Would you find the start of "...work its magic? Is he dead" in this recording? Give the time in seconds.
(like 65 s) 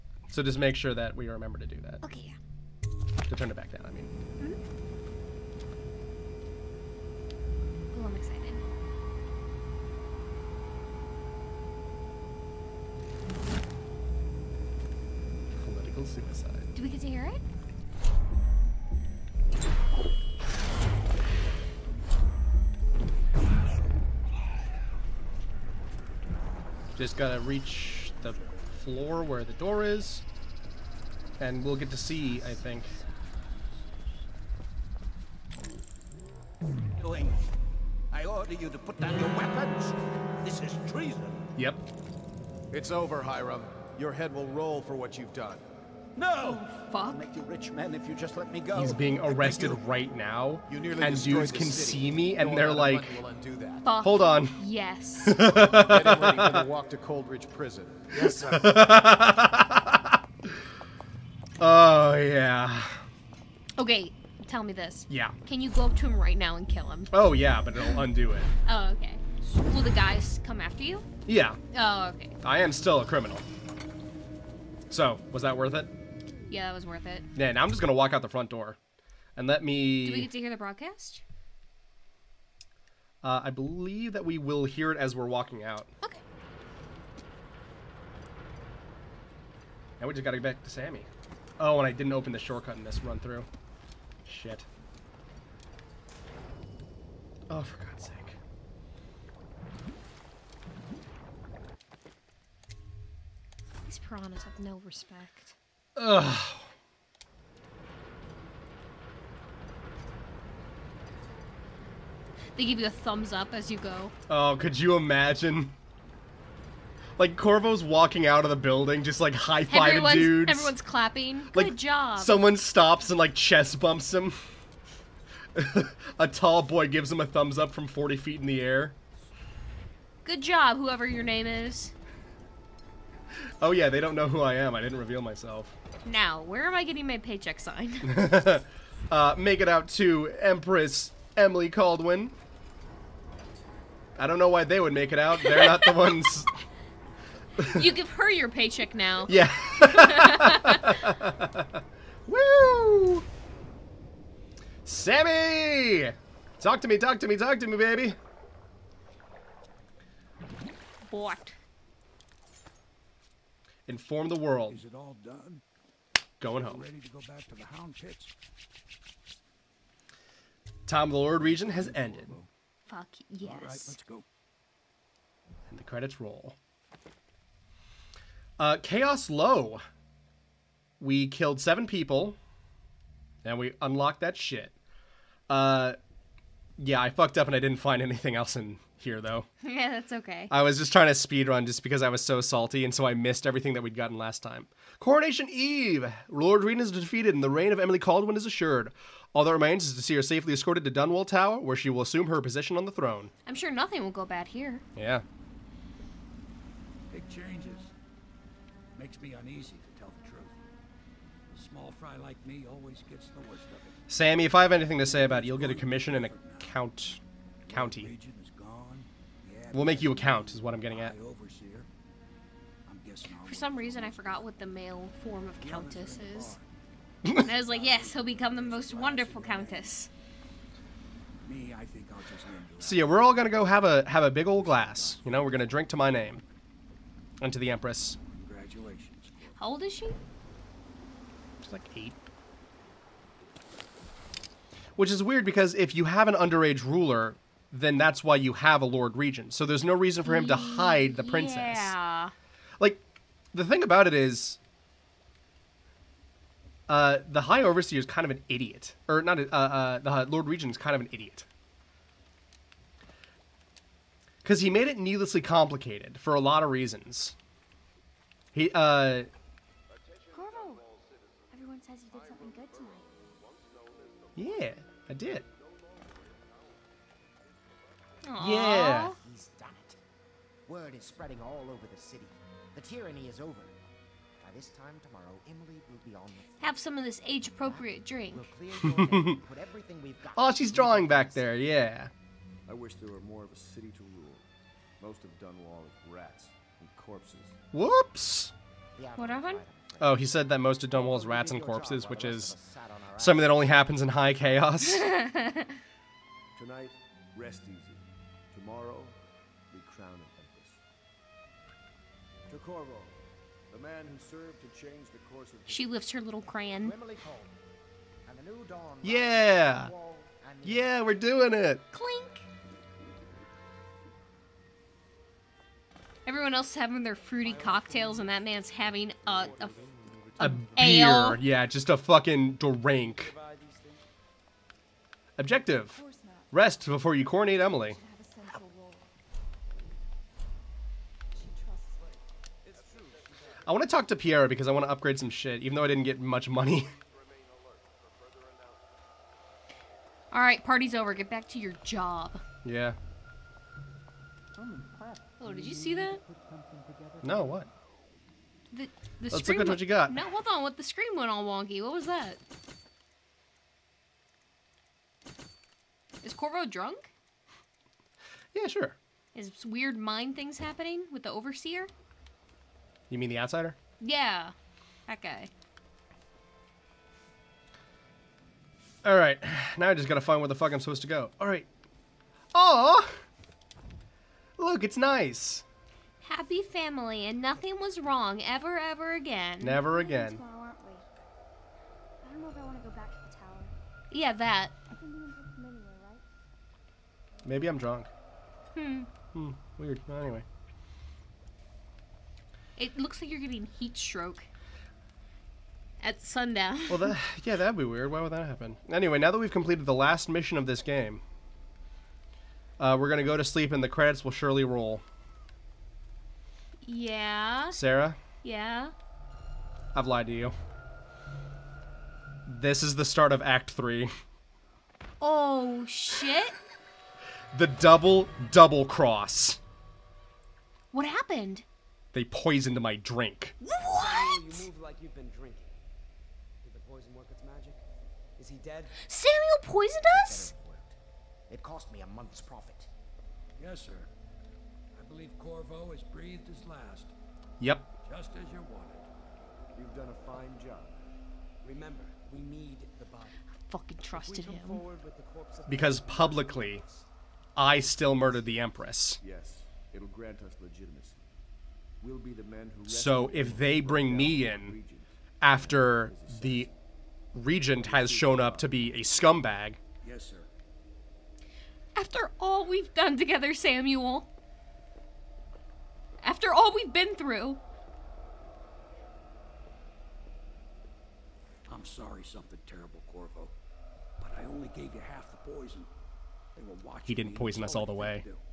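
437 s.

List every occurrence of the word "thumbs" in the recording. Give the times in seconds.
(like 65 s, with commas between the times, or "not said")
112 s, 127 s.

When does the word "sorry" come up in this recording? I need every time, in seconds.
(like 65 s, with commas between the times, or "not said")
481 s.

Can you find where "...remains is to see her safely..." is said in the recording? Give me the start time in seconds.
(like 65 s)
199 s.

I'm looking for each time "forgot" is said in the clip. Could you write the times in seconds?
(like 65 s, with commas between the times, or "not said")
224 s.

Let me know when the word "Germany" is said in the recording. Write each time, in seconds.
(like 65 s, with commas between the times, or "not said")
not said.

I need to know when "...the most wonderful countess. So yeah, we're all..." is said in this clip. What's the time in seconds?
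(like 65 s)
228 s.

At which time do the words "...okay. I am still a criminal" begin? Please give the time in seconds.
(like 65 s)
72 s.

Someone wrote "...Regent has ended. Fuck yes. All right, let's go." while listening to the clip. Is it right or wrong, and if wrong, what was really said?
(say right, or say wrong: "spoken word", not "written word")
right.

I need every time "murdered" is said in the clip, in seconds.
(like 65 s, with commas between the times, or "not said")
458 s.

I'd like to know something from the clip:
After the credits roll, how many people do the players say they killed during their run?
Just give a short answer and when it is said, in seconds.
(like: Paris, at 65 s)
7, at 181 s.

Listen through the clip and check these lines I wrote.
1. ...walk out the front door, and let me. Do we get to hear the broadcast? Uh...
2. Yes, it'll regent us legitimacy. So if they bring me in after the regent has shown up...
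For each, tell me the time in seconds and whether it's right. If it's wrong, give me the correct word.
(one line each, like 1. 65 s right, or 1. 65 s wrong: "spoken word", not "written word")
1. 77 s right
2. 459 s wrong: "grant", not "regent".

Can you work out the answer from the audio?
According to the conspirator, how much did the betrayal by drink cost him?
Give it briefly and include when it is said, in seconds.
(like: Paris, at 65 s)
A month's profit, at 442 s.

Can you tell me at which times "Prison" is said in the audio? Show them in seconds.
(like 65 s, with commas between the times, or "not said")
57 s.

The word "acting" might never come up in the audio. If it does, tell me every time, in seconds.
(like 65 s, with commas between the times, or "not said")
not said.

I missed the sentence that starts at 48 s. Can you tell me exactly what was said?
He's being arrested right now, and dudes can city.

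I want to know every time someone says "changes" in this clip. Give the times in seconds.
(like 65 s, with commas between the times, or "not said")
207 s, 314 s.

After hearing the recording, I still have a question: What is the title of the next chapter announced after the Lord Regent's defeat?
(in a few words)
Coronation Eve.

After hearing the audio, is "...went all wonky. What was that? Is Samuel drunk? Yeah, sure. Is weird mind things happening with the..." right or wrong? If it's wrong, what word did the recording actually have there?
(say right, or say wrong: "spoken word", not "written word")
wrong: "Corvo", not "Samuel".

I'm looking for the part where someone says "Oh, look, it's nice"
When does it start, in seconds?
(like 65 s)
382 s.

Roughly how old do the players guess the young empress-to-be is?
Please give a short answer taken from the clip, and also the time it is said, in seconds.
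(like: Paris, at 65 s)
8, at 241 s.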